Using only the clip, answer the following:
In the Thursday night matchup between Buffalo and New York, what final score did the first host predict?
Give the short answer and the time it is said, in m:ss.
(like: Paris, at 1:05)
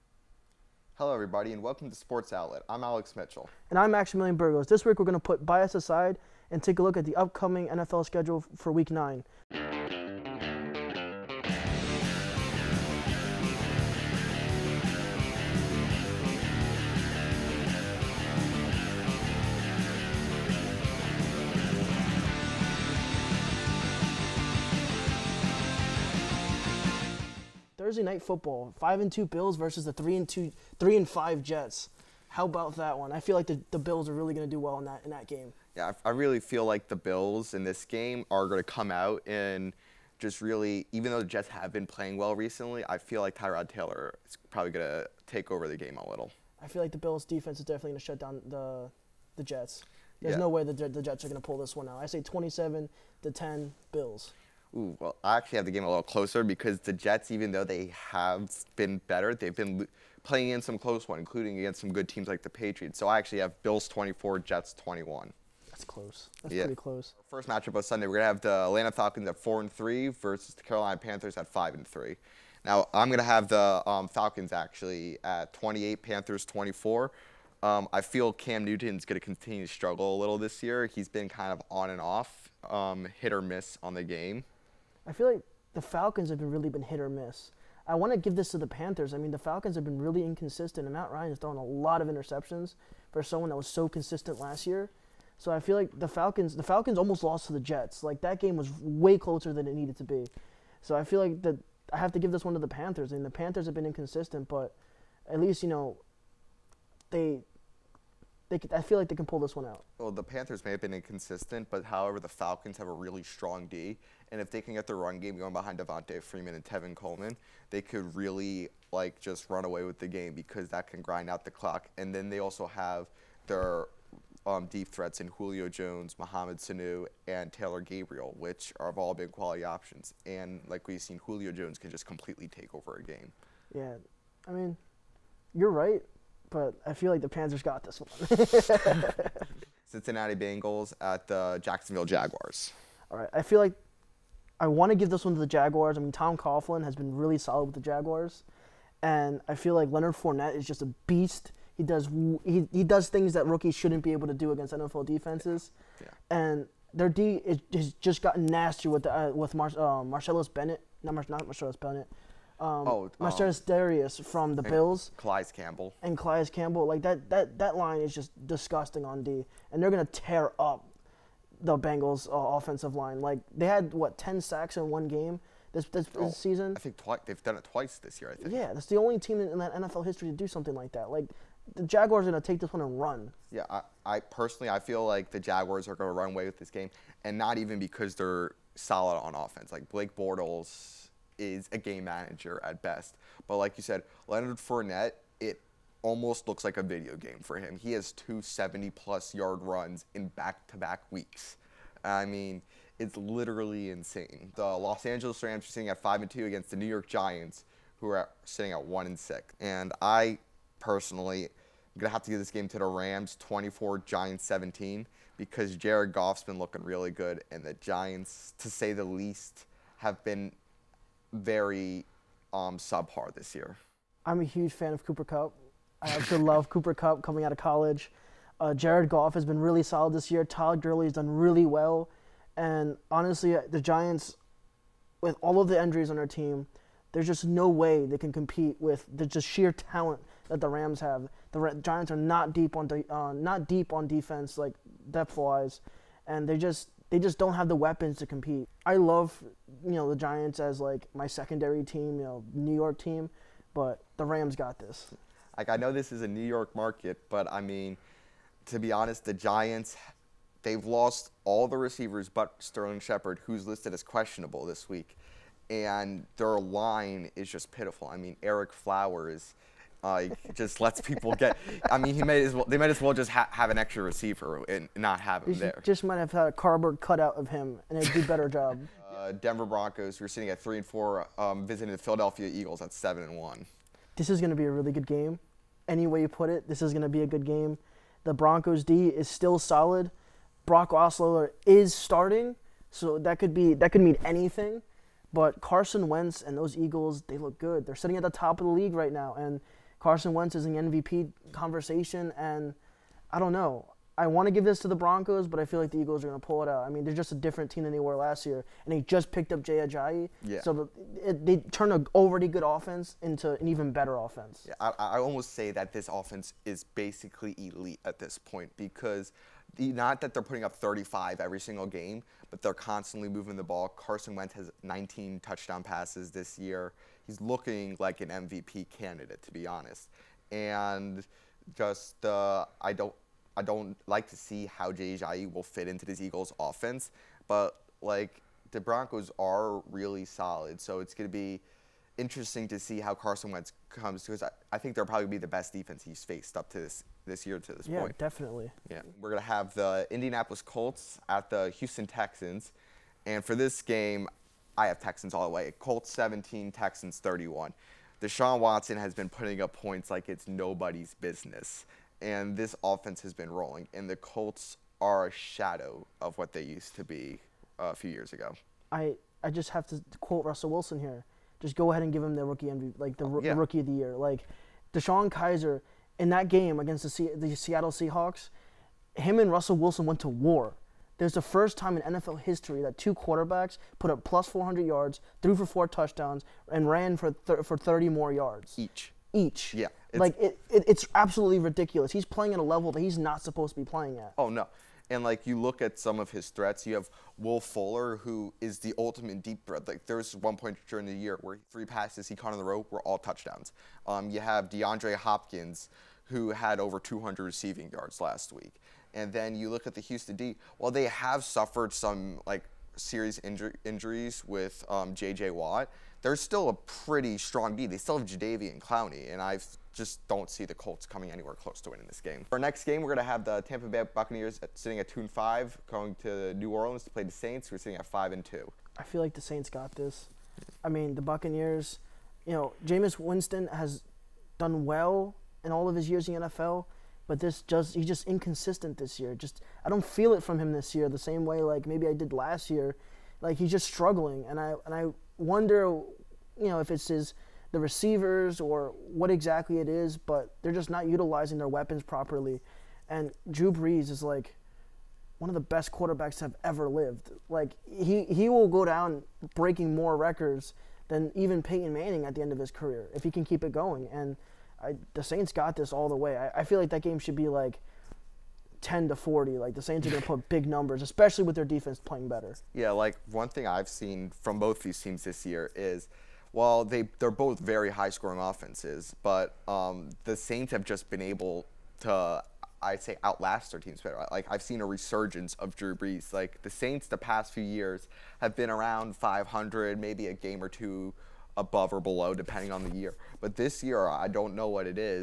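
27 to 10 Bills, at 0:52.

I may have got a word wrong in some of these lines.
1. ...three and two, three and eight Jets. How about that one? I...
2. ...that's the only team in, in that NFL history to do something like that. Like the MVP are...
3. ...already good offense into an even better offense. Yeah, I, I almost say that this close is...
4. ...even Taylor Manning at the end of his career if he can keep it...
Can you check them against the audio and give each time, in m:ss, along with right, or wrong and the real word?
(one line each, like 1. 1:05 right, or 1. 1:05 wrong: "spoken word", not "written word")
1. 0:29 wrong: "five", not "eight"
2. 2:58 wrong: "Jaguars", not "MVP"
3. 5:12 wrong: "offense", not "close"
4. 7:41 wrong: "Peyton", not "Taylor".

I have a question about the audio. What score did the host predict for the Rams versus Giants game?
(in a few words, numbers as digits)
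Rams 24, Giants 17.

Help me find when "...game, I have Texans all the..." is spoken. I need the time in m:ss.
5:53.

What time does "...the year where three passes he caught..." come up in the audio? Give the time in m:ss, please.
6:41.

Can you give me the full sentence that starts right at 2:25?
I mean, Tom Coughlin has been really solid with the Jaguars, and I feel like Leonard Fournette is just a beast.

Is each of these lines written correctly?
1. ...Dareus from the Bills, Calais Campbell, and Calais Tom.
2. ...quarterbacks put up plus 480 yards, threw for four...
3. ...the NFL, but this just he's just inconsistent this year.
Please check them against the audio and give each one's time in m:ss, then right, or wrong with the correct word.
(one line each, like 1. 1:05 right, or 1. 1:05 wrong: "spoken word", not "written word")
1. 2:43 wrong: "Campbell", not "Tom"
2. 6:23 wrong: "400", not "480"
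3. 7:16 right.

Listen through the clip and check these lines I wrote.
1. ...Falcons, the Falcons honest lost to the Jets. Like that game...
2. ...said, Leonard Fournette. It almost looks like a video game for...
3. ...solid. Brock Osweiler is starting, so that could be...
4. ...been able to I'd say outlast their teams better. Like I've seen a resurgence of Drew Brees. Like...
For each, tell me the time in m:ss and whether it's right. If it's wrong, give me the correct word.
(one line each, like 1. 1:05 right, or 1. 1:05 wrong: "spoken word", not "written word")
1. 1:36 wrong: "almost", not "honest"
2. 3:13 right
3. 4:49 right
4. 8:01 right.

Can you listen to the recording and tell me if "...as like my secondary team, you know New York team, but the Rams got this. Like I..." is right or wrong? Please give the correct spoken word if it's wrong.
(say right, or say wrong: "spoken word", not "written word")
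right.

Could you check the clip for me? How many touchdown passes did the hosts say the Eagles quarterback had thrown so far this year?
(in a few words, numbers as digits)
19.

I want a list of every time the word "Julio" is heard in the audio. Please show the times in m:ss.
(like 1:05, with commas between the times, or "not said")
2:05, 2:11.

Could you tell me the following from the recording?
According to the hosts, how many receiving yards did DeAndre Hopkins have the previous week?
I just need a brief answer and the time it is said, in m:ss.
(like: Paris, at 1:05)
over 200, at 6:46.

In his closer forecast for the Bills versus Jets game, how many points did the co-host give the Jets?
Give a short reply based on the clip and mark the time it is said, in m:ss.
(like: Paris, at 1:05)
21, at 1:04.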